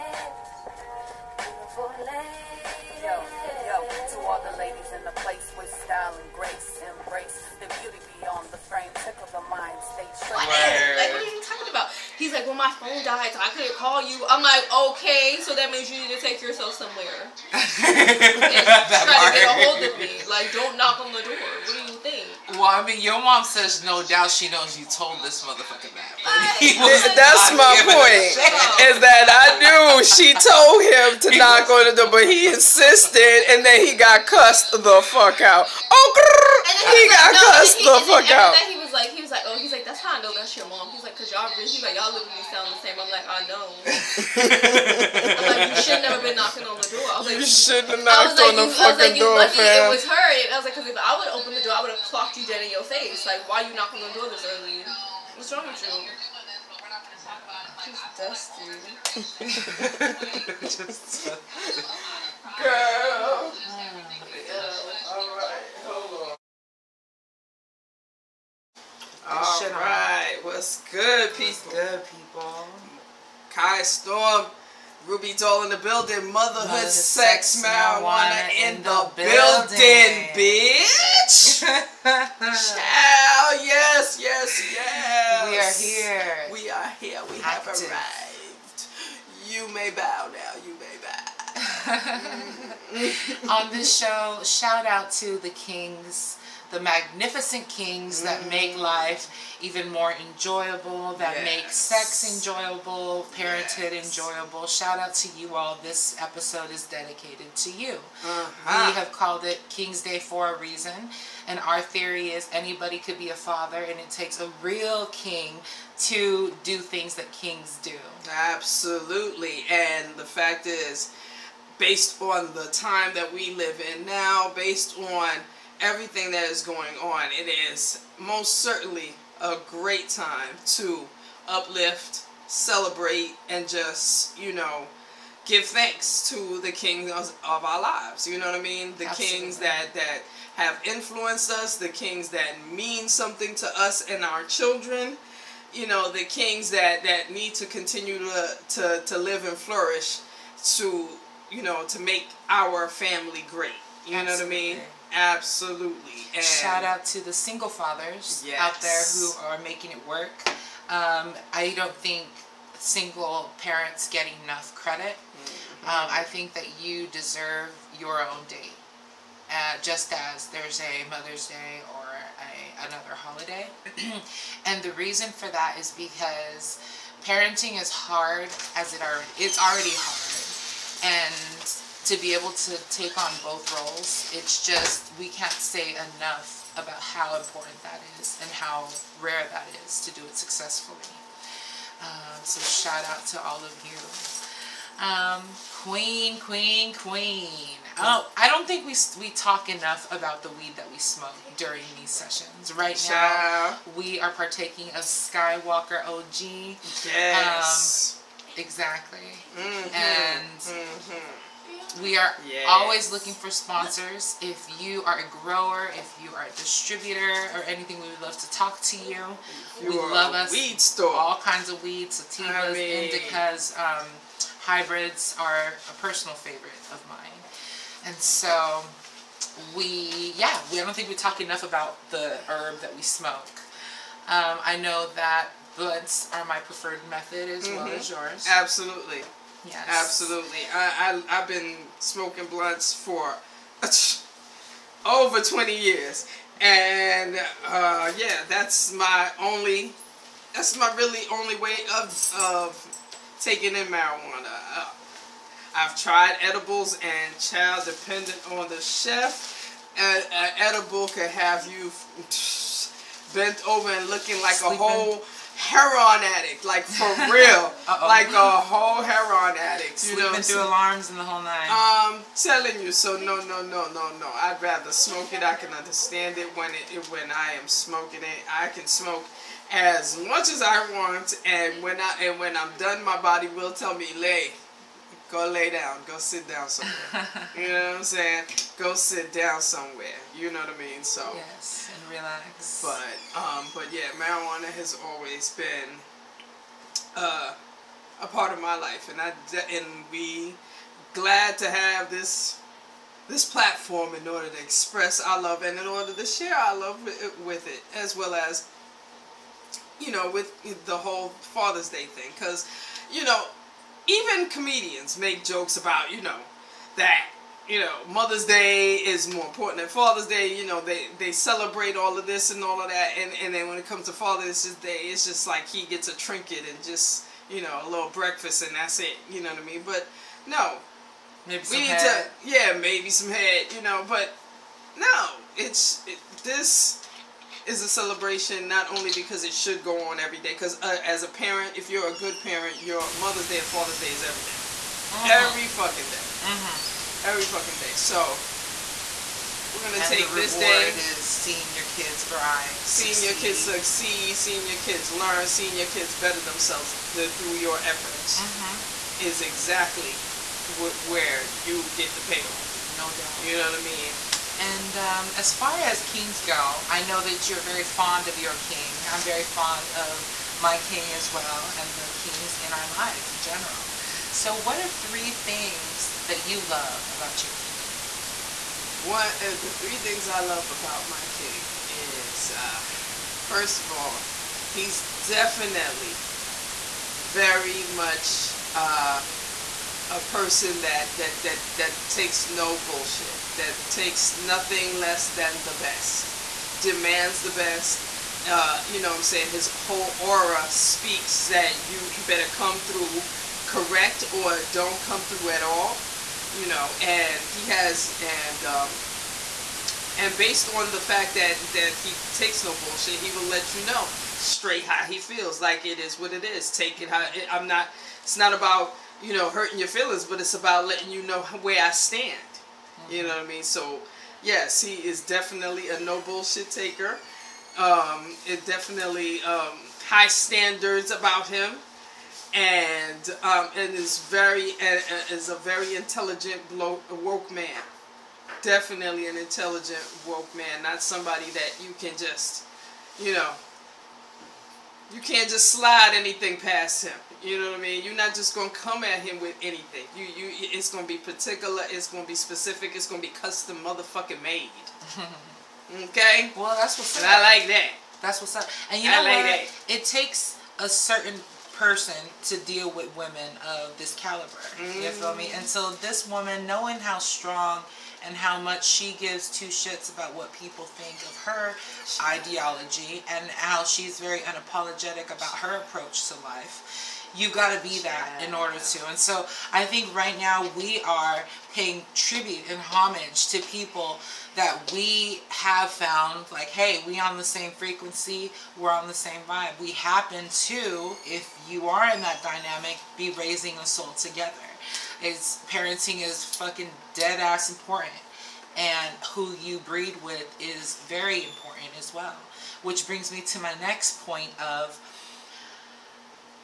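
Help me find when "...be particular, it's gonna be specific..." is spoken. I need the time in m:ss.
7:31.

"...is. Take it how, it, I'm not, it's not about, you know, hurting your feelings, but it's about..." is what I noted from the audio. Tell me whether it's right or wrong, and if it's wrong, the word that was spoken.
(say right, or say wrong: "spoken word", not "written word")
right.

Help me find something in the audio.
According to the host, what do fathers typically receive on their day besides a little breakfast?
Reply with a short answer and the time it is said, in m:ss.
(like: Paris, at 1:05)
A trinket, at 5:26.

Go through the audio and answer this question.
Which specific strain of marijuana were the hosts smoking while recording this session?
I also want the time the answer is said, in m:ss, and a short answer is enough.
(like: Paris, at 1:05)
Skywalker OG, at 3:25.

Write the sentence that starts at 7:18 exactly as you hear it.
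Definitely an intelligent woke man, not somebody that you can just, you know, you can't just slide anything past him.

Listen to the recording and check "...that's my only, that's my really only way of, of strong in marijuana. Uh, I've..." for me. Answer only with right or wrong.
wrong.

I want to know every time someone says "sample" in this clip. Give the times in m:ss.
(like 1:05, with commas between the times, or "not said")
not said.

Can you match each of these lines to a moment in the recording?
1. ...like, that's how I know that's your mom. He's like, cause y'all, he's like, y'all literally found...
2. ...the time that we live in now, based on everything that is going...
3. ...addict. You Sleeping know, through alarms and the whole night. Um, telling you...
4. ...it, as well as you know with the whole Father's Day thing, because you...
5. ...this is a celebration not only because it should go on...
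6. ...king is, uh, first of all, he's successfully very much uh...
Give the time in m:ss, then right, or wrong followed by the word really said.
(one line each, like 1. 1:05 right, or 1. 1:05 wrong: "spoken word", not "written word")
1. 0:39 wrong: "sound", not "found"
2. 2:02 right
3. 4:29 right
4. 5:07 right
5. 5:36 right
6. 6:21 wrong: "definitely", not "successfully".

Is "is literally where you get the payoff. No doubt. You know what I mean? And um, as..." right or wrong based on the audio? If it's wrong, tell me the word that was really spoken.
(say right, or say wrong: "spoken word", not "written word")
wrong: "exactly", not "literally".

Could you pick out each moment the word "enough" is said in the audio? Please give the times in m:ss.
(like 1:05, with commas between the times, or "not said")
2:44, 3:05, 3:19, 3:51.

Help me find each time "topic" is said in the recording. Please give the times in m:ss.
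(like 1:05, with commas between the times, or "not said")
not said.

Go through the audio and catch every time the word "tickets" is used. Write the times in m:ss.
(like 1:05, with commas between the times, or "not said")
not said.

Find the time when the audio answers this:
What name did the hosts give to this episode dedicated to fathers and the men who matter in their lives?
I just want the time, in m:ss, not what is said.
1:49.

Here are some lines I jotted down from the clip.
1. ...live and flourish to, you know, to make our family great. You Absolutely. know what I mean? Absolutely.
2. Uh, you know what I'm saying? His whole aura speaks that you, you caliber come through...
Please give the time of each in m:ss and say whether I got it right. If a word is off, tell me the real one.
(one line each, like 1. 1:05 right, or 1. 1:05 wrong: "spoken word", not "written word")
1. 2:29 right
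2. 6:38 wrong: "better", not "caliber".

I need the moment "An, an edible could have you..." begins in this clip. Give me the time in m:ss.
4:19.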